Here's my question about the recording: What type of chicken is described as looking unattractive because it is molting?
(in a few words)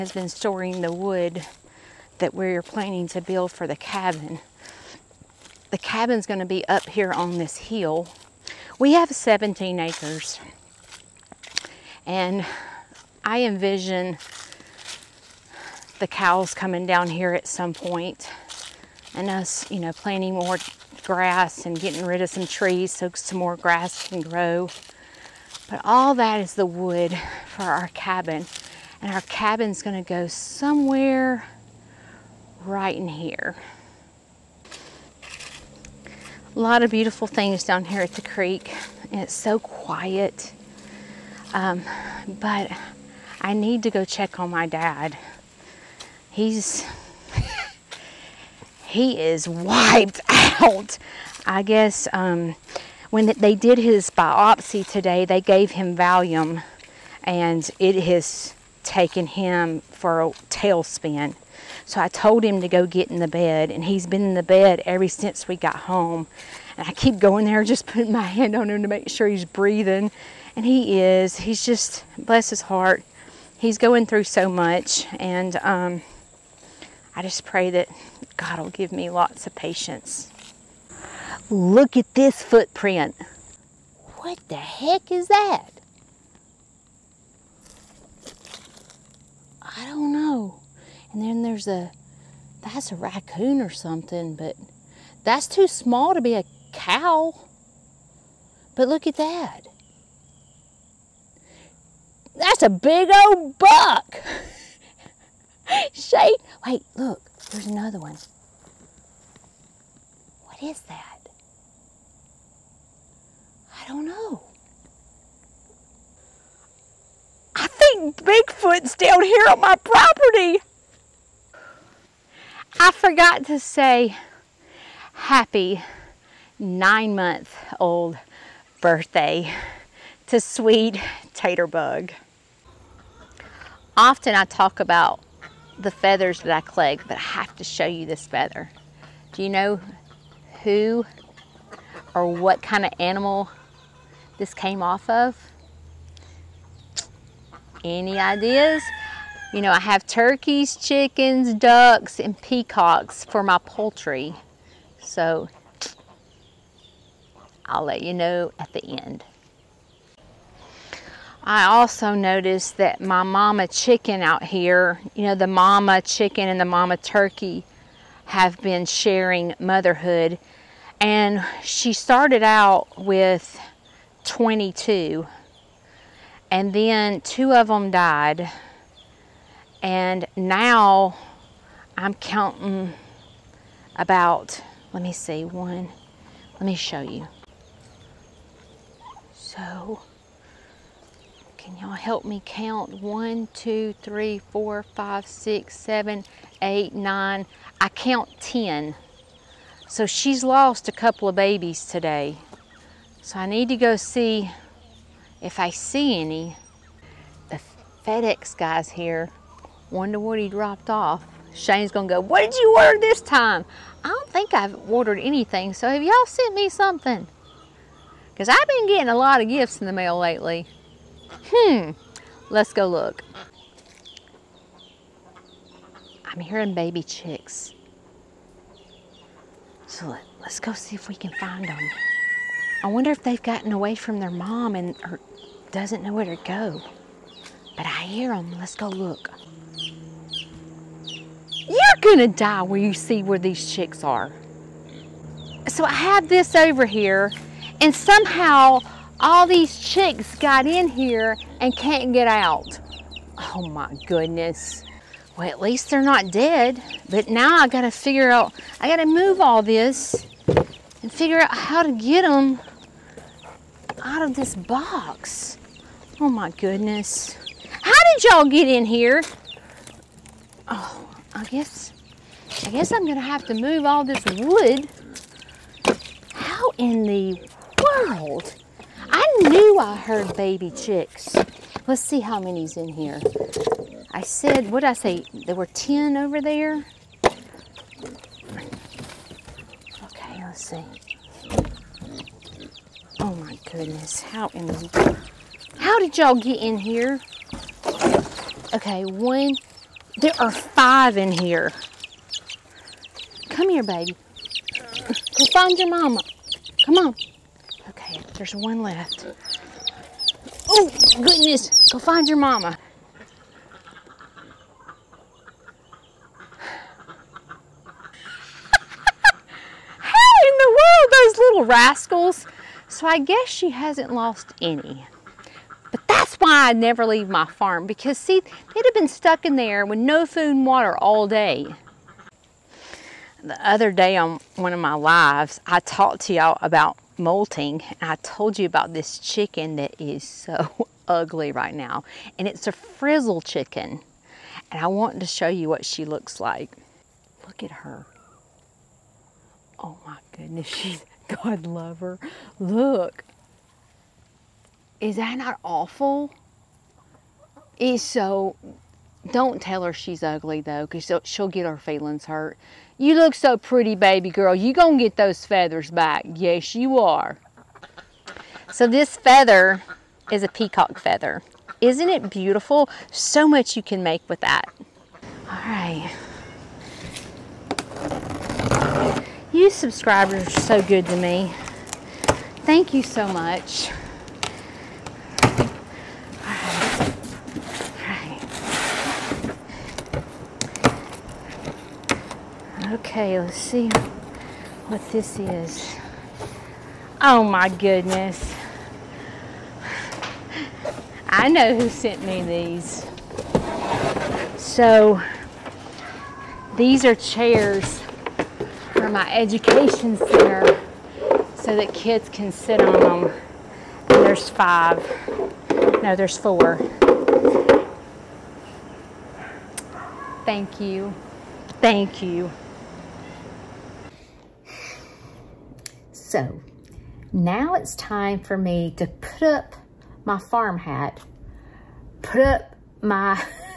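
Frizzle.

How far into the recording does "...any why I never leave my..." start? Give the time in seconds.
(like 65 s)
324 s.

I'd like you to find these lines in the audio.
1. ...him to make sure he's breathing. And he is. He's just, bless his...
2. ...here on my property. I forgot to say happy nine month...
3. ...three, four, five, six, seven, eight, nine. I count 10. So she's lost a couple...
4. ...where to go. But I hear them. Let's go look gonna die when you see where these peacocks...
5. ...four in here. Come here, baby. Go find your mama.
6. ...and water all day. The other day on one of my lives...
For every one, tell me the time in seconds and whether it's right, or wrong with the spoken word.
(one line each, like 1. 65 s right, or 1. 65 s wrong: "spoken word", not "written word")
1. 68 s right
2. 119 s right
3. 194 s right
4. 236 s wrong: "chicks", not "peacocks"
5. 300 s wrong: "five", not "four"
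6. 330 s right.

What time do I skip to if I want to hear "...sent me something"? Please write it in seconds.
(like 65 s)
216 s.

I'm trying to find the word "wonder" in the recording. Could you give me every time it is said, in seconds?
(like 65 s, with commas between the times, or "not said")
209 s, 232 s.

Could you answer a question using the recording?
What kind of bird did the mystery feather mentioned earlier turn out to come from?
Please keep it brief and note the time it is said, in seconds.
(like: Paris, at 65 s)
Peacock, at 370 s.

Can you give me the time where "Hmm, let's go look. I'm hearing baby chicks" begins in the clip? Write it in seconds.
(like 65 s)
221 s.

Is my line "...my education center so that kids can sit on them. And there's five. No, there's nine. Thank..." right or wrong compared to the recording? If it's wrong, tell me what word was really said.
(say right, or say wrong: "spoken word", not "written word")
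wrong: "four", not "nine".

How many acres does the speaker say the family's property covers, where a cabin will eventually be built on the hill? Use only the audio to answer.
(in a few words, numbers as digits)
17.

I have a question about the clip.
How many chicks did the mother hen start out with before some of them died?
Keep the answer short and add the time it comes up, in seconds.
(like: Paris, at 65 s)
22, at 174 s.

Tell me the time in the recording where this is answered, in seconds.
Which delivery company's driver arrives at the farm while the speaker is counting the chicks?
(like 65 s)
208 s.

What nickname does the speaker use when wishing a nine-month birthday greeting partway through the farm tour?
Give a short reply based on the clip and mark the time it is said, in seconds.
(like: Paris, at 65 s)
Taterbug, at 131 s.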